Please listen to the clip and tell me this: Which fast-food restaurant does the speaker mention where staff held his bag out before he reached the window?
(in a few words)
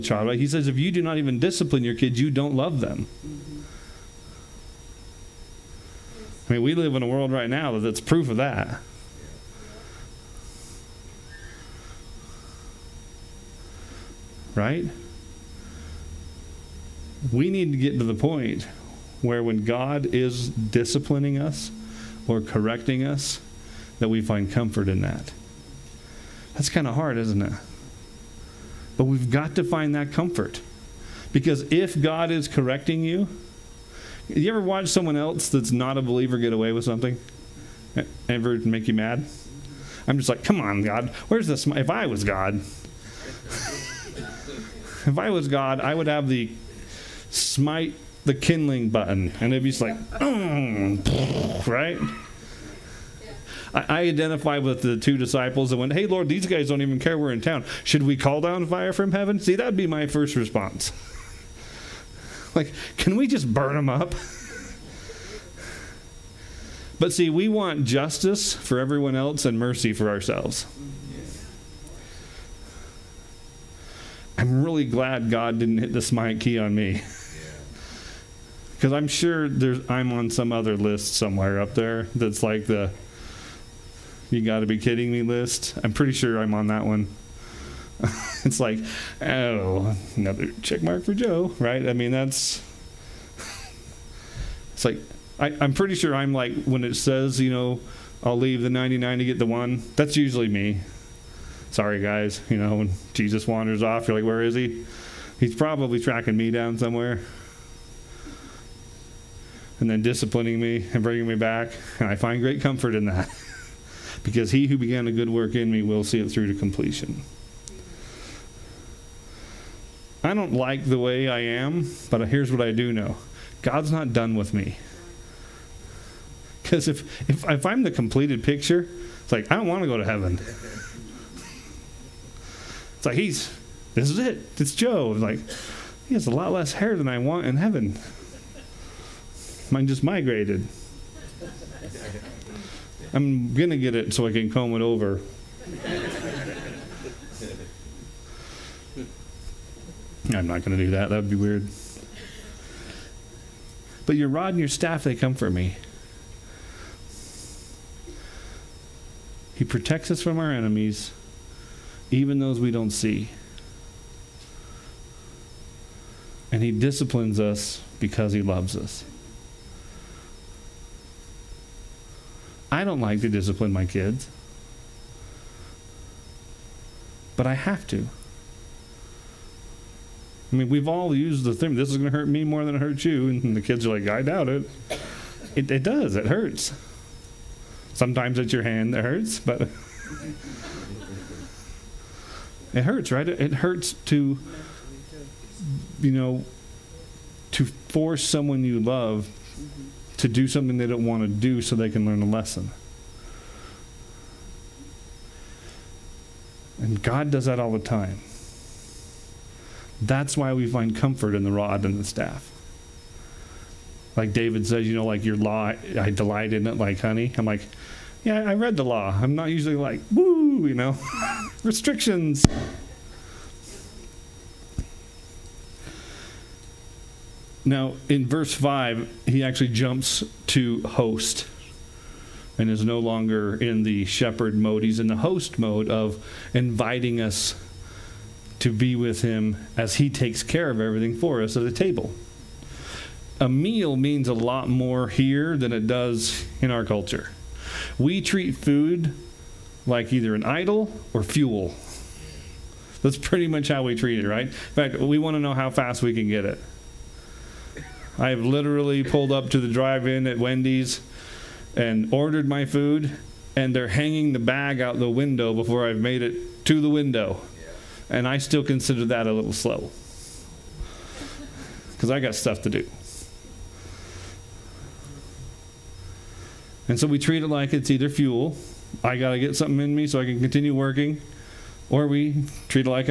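Wendy's.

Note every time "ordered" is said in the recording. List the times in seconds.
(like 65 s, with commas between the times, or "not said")
262 s.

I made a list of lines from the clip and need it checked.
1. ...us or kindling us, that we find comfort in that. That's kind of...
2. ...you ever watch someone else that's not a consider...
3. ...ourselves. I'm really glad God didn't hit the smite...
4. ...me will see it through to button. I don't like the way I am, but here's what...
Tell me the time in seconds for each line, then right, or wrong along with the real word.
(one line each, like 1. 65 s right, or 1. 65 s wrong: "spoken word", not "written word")
1. 21 s wrong: "correcting", not "kindling"
2. 34 s wrong: "believer", not "consider"
3. 70 s right
4. 115 s wrong: "completion", not "button".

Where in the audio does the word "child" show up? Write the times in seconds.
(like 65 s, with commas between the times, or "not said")
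0 s.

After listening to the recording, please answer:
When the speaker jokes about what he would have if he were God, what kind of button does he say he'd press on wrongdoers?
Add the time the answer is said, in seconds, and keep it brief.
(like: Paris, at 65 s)
smite the kindling button, at 47 s.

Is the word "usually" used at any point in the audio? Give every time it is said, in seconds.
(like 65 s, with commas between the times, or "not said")
100 s, 219 s.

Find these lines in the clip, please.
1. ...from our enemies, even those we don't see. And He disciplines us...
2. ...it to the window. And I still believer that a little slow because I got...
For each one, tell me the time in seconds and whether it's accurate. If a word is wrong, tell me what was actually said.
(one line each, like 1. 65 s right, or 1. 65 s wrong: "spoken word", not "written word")
1. 160 s right
2. 266 s wrong: "consider", not "believer".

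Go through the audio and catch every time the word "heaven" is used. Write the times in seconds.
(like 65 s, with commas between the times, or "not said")
59 s, 130 s, 137 s.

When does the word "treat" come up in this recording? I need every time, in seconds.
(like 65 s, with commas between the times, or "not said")
248 s, 253 s, 277 s.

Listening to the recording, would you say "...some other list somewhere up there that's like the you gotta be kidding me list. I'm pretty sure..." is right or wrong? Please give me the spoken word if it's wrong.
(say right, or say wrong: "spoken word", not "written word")
right.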